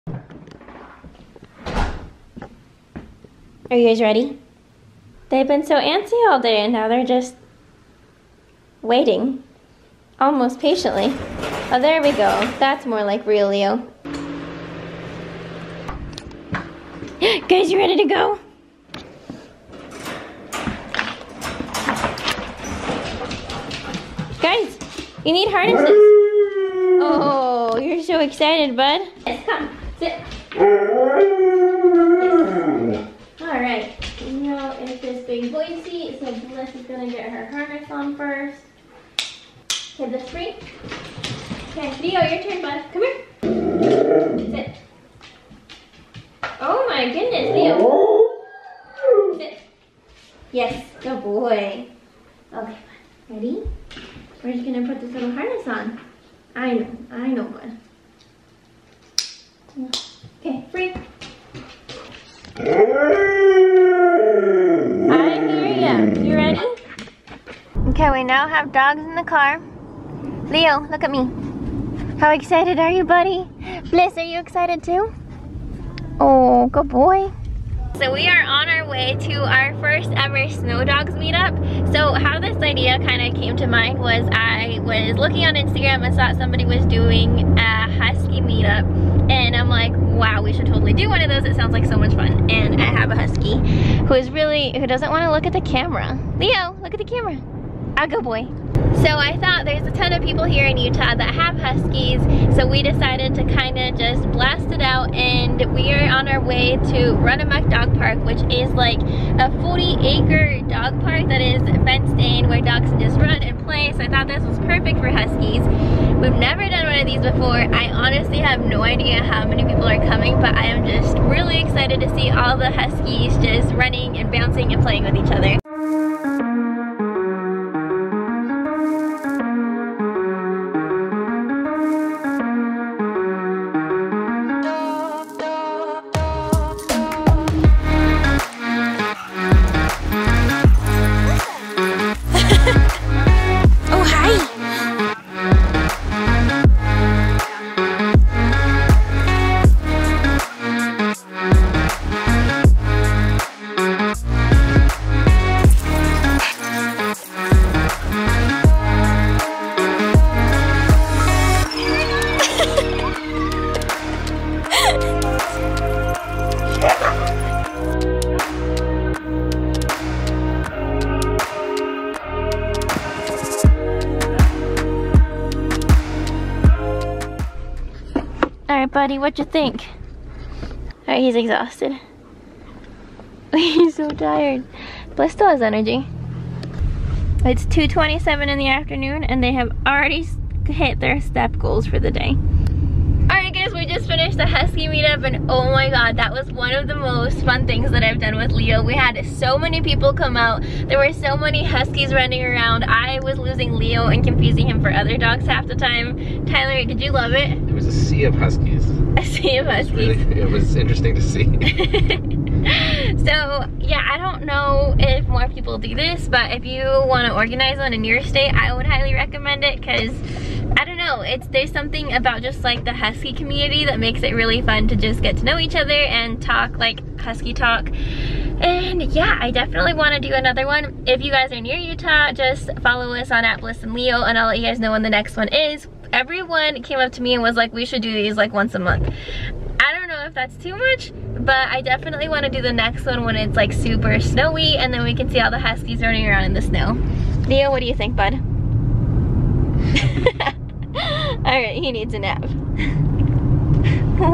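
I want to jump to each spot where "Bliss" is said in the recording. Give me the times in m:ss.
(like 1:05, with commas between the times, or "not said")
0:36, 1:13, 3:53.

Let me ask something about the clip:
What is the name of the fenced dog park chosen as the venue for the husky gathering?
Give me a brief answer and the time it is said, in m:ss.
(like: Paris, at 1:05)
Runamuk Dog Park, at 1:47.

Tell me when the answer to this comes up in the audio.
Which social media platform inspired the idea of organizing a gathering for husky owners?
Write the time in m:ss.
1:25.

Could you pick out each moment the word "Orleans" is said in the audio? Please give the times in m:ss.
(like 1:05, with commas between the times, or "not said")
not said.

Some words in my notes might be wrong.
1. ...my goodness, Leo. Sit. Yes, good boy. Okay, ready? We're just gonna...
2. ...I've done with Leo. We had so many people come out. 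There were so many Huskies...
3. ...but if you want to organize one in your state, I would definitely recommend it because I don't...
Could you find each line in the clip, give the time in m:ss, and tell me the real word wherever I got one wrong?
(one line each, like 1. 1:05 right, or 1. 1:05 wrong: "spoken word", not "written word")
1. 0:46 right
2. 3:18 right
3. 3:36 wrong: "highly", not "definitely".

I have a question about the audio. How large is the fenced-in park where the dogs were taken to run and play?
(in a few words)
40 acres.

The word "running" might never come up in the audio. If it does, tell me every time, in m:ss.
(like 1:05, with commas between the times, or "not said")
2:03, 3:22, 4:06.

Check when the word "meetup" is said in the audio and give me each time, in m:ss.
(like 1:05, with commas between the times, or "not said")
1:21, 1:28, 3:14.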